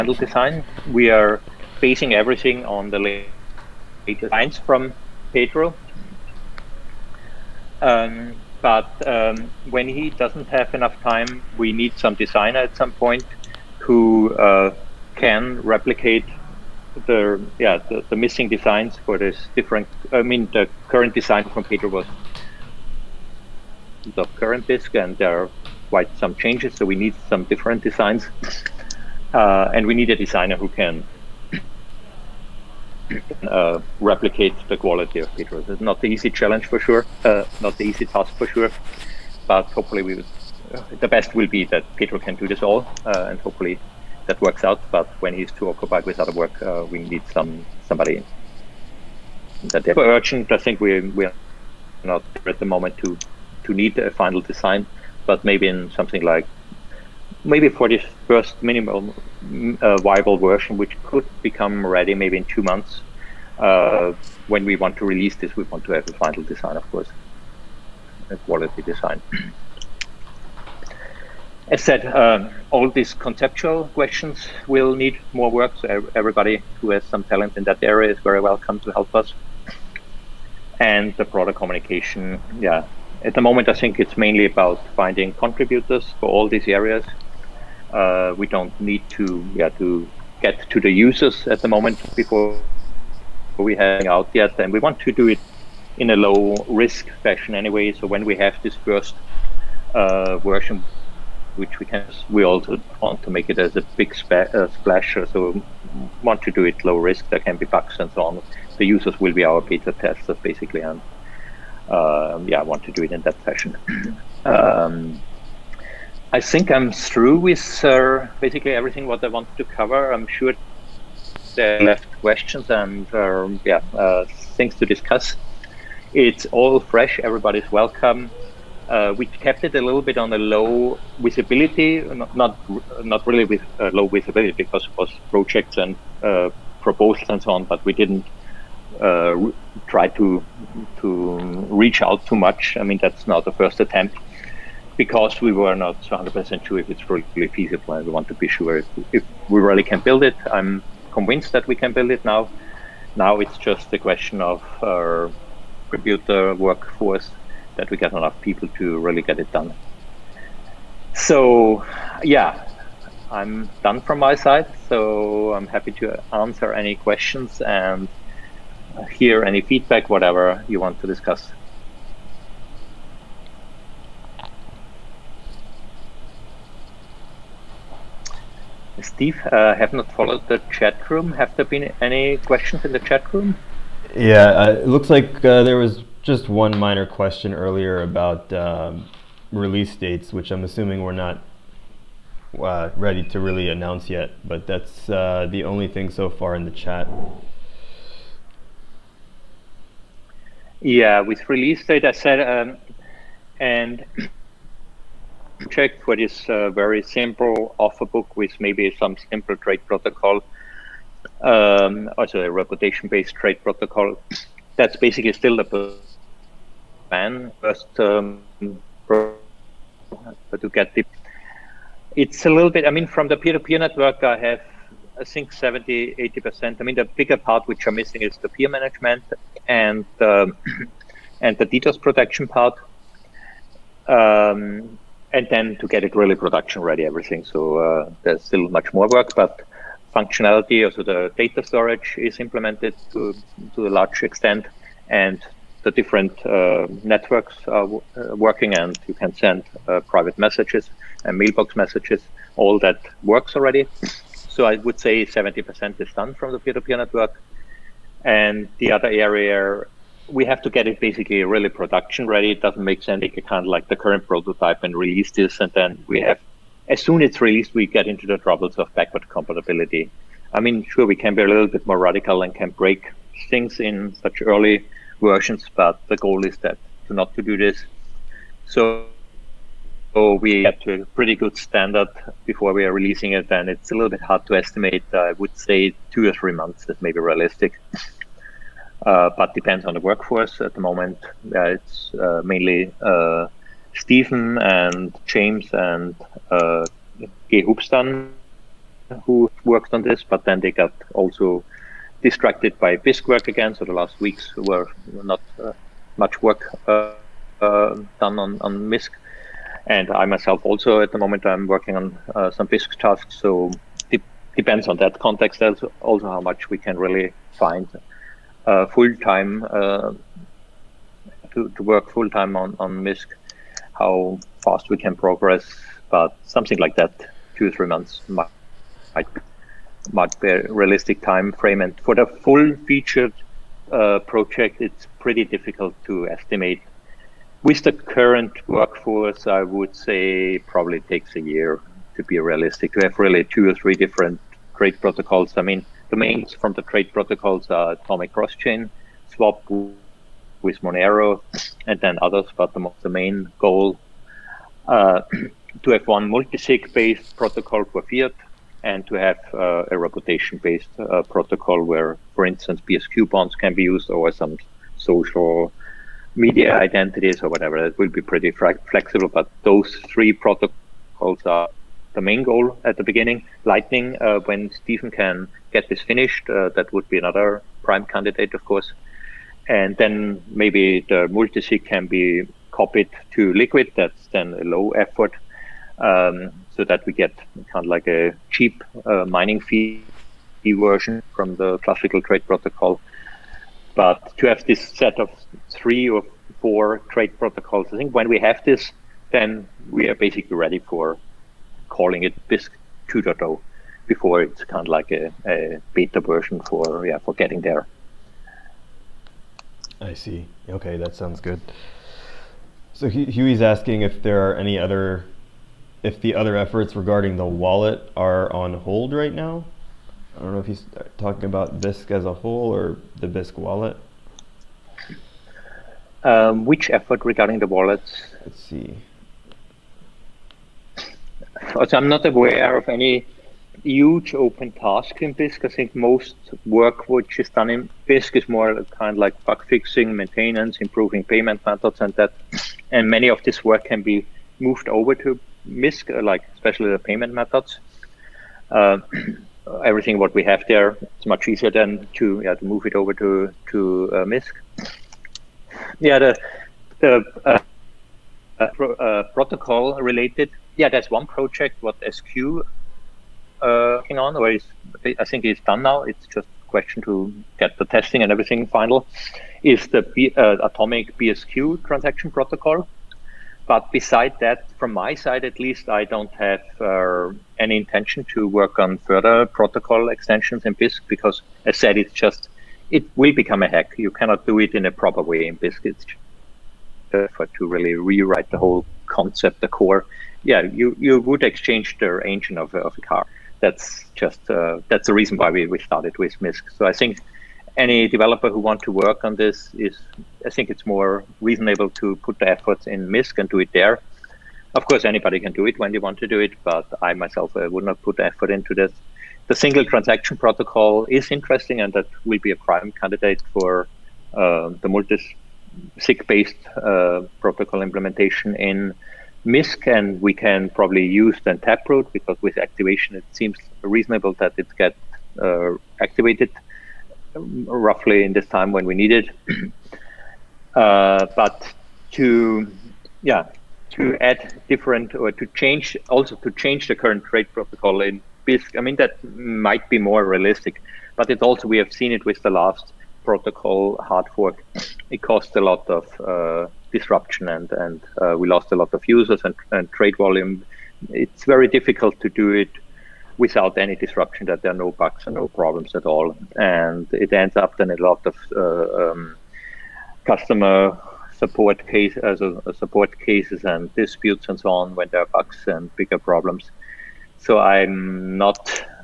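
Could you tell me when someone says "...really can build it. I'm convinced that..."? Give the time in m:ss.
2:29.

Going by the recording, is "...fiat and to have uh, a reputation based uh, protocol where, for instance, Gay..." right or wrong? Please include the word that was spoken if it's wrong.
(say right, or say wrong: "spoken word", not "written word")
wrong: "PSQ", not "Gay".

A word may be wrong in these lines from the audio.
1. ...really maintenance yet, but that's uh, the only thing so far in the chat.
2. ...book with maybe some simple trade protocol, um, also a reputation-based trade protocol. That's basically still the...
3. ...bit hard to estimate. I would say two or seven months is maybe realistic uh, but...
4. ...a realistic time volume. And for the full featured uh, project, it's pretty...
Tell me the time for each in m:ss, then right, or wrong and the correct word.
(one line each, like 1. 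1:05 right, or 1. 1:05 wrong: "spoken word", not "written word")
1. 3:13 wrong: "announce", not "maintenance"
2. 3:28 right
3. 4:44 wrong: "three", not "seven"
4. 5:30 wrong: "frame", not "volume".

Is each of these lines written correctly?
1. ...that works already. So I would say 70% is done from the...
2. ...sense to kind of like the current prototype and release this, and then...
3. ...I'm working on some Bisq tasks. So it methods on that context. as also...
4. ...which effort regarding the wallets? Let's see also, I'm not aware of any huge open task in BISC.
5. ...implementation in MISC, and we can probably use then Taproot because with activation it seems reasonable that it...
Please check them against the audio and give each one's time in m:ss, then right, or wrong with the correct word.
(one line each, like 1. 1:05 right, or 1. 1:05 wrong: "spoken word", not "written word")
1. 4:12 right
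2. 4:23 right
3. 5:11 wrong: "depends", not "methods"
4. 7:06 right
5. 8:37 right.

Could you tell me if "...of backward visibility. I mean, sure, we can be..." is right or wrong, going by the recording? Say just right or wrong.
wrong.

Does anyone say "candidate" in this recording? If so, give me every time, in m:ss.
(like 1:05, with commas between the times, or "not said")
6:18, 8:32.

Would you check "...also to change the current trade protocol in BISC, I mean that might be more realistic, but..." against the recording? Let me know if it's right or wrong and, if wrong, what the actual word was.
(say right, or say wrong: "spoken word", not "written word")
right.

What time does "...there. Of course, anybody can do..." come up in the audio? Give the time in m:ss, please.
8:23.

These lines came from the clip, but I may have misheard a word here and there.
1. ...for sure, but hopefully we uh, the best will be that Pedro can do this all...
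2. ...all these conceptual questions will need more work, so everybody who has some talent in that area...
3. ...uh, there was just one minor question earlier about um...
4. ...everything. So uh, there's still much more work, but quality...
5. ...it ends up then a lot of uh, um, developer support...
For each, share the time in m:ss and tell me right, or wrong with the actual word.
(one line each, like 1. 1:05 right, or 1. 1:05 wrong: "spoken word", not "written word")
1. 0:38 right
2. 1:12 right
3. 3:05 right
4. 3:57 wrong: "functionality", not "quality"
5. 9:17 wrong: "customer", not "developer".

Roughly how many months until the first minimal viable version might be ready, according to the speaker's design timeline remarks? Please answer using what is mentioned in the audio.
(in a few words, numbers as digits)
2.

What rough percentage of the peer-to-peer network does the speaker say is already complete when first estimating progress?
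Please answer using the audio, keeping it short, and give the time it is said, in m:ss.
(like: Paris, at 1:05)
70-80%, at 3:45.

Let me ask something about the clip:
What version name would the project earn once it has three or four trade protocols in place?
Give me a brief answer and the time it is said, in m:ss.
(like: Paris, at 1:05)
Bisq 2.0, at 6:42.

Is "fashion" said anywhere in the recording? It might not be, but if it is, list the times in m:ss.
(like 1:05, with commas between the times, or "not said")
1:37, 1:53.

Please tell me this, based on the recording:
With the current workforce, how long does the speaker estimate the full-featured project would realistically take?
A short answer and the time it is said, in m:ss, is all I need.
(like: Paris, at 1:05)
a year, at 5:41.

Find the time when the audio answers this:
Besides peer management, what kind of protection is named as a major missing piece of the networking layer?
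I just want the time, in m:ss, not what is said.
3:51.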